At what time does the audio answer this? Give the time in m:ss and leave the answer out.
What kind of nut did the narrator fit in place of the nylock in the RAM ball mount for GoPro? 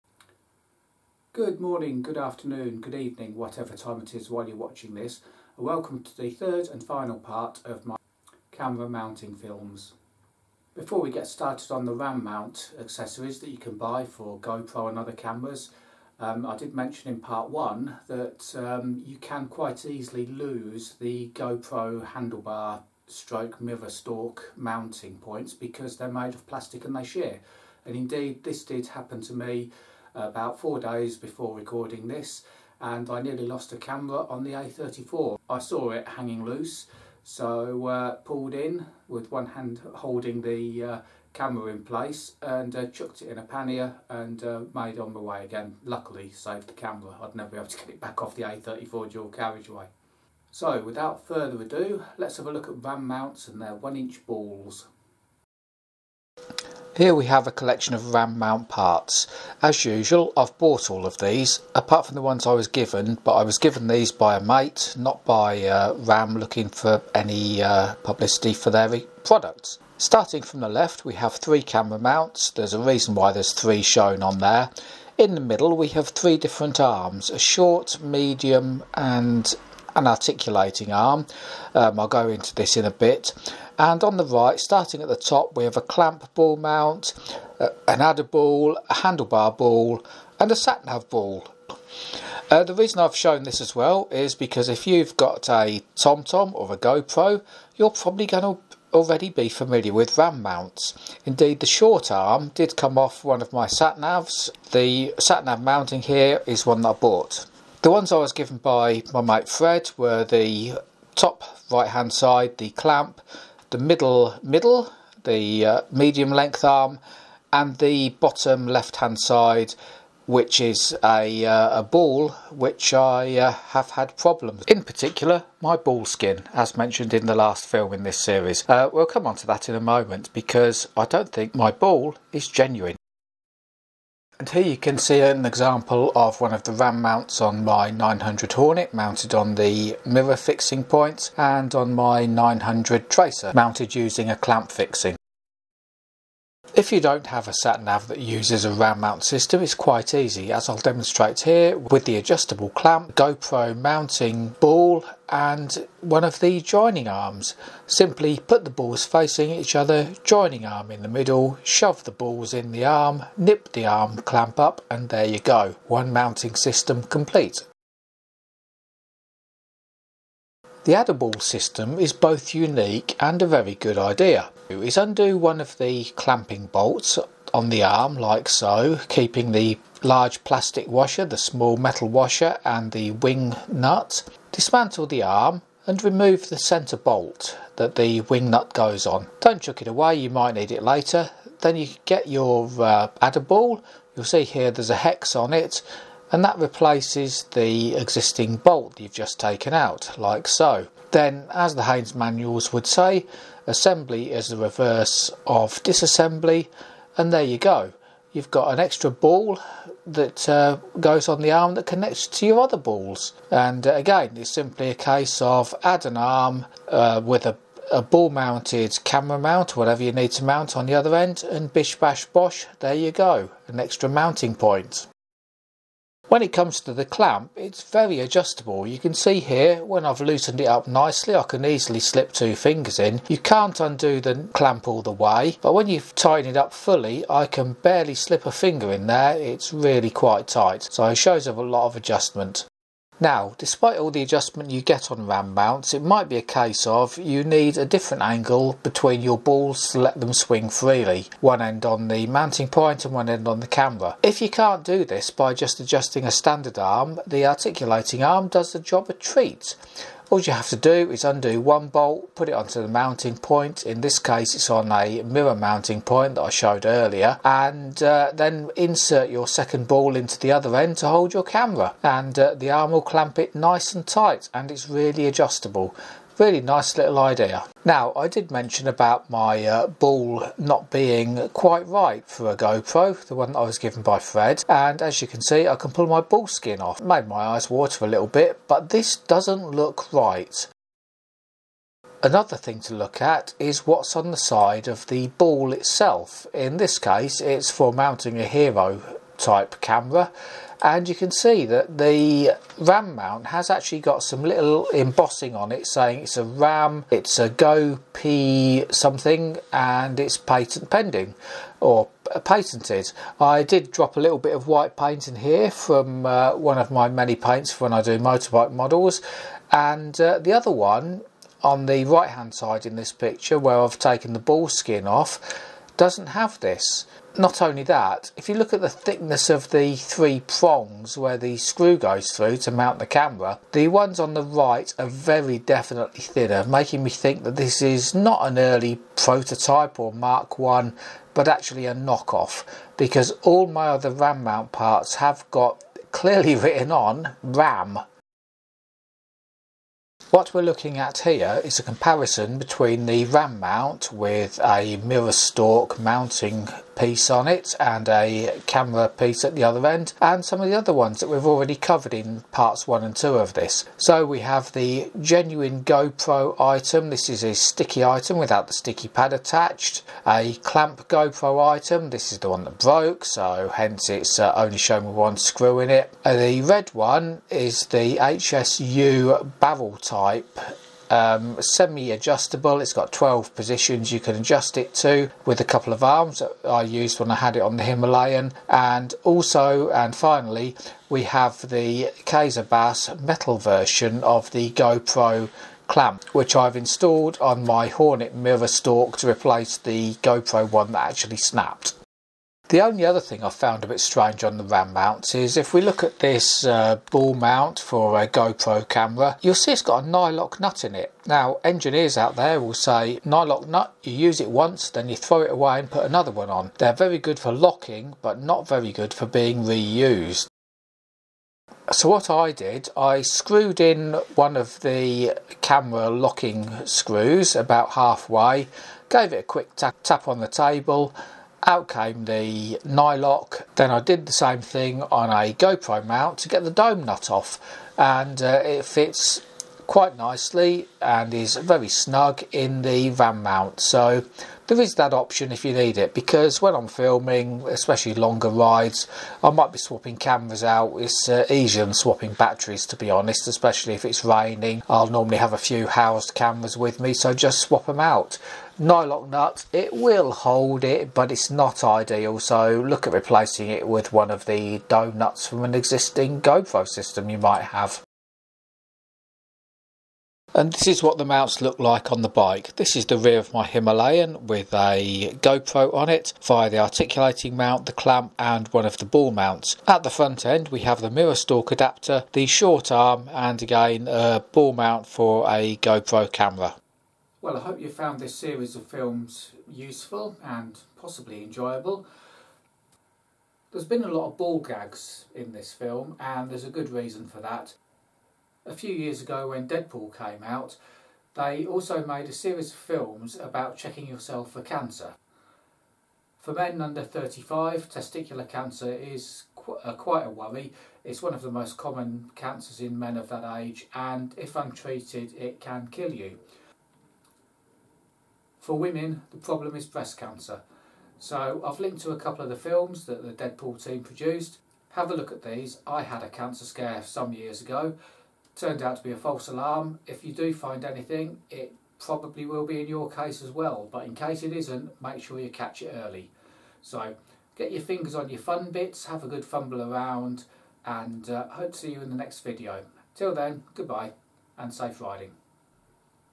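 7:16.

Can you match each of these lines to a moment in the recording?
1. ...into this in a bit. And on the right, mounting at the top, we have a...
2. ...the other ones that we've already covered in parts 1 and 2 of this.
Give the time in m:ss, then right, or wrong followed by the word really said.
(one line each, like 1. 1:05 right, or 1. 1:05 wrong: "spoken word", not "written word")
1. 1:22 wrong: "starting", not "mounting"
2. 6:00 right.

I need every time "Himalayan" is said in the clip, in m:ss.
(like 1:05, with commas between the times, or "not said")
6:27, 7:53.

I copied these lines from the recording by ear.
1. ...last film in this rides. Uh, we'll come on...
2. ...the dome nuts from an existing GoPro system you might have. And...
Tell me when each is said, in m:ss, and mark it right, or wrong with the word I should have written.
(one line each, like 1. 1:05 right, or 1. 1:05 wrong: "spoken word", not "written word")
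1. 2:07 wrong: "series", not "rides"
2. 7:44 right.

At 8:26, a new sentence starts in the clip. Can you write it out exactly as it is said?
For men under 35, testicular cancer is qu uh, quite a worry.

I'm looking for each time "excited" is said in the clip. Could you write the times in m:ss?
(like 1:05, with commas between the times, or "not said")
not said.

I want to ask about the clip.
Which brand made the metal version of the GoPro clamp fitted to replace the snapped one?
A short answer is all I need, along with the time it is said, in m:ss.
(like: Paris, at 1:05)
Kaiser Baas, at 6:32.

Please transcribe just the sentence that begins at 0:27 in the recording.
And indeed, this did happen to me about four days before recording this and I nearly lost a camera on the A34.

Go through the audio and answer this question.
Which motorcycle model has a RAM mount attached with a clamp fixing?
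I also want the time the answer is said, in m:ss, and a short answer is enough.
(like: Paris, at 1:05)
900 Tracer, at 2:22.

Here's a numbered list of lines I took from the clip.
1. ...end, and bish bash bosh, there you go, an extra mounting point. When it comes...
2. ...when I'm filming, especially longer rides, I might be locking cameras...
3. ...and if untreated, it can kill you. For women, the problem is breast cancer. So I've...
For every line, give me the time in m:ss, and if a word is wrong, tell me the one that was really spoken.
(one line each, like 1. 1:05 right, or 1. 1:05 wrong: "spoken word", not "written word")
1. 3:41 right
2. 7:26 wrong: "swapping", not "locking"
3. 8:33 right.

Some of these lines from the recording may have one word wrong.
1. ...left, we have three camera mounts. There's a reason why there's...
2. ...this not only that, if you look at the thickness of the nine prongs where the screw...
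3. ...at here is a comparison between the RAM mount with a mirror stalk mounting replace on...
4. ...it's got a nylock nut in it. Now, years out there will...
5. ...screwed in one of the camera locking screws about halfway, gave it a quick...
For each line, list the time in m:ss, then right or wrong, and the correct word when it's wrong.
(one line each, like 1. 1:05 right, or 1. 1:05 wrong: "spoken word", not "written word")
1. 1:10 right
2. 5:26 wrong: "three", not "nine"
3. 5:50 wrong: "piece", not "replace"
4. 6:49 wrong: "engineers", not "years"
5. 7:03 right.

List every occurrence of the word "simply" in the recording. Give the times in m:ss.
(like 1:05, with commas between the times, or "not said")
2:37, 3:34.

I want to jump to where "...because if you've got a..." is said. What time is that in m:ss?
1:34.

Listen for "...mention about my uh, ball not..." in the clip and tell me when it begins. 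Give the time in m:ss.
4:38.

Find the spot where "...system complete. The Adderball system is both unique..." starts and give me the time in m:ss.
2:46.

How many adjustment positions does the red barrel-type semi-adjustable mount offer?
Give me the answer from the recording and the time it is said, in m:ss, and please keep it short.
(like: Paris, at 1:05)
12, at 6:23.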